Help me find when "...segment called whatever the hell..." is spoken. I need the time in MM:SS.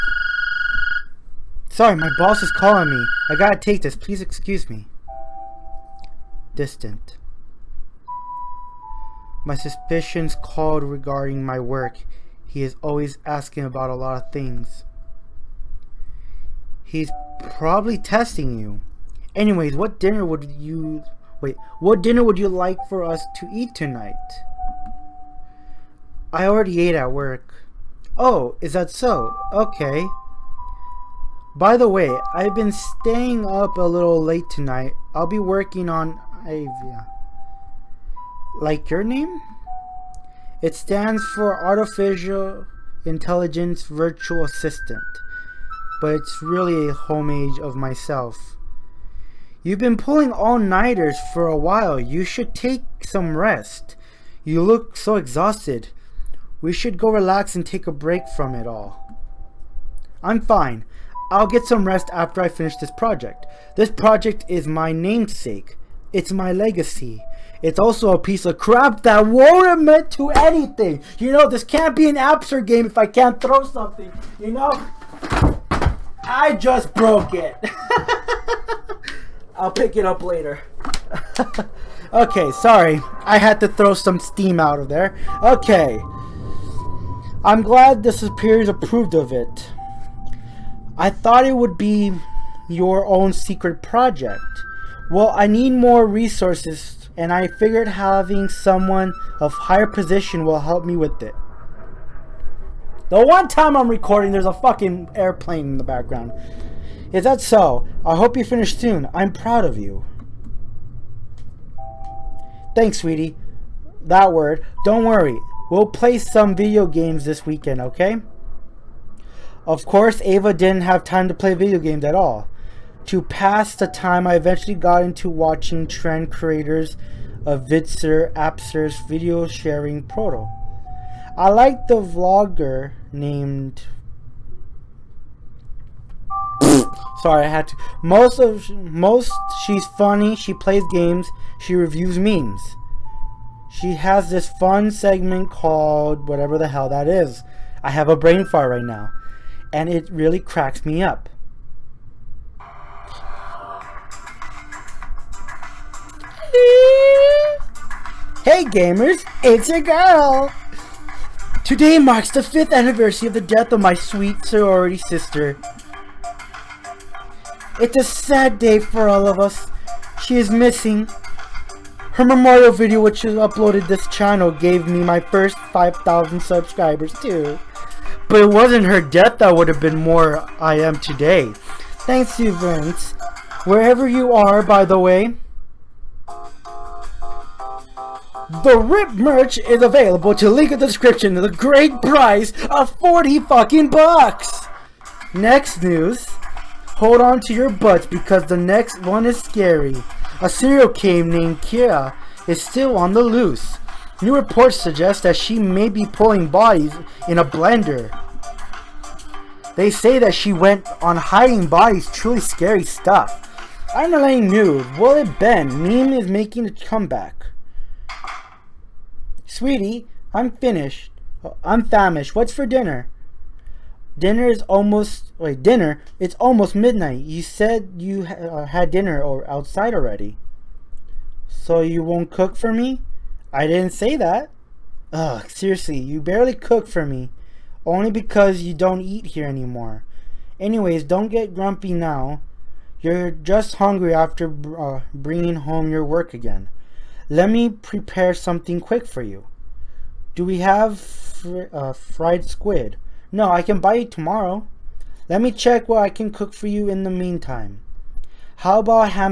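02:24.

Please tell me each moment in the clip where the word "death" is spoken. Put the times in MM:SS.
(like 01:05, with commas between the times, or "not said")
02:43, 02:59.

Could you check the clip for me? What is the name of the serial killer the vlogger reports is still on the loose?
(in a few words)
Kira.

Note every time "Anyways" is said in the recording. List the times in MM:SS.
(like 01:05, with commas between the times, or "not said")
00:19, 04:00.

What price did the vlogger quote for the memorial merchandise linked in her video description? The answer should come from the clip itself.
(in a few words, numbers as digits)
40 bucks.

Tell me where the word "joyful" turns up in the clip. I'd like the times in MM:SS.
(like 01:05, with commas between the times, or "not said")
not said.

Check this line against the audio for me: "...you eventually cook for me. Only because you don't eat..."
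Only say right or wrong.
wrong.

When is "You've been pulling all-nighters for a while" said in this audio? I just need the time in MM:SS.
00:49.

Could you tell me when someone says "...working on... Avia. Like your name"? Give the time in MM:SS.
00:35.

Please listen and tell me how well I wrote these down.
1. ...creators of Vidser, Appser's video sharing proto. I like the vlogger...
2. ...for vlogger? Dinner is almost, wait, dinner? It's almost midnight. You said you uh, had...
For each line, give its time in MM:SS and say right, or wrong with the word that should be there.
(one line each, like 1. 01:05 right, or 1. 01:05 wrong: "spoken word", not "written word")
1. 02:06 right
2. 03:42 wrong: "dinner", not "vlogger".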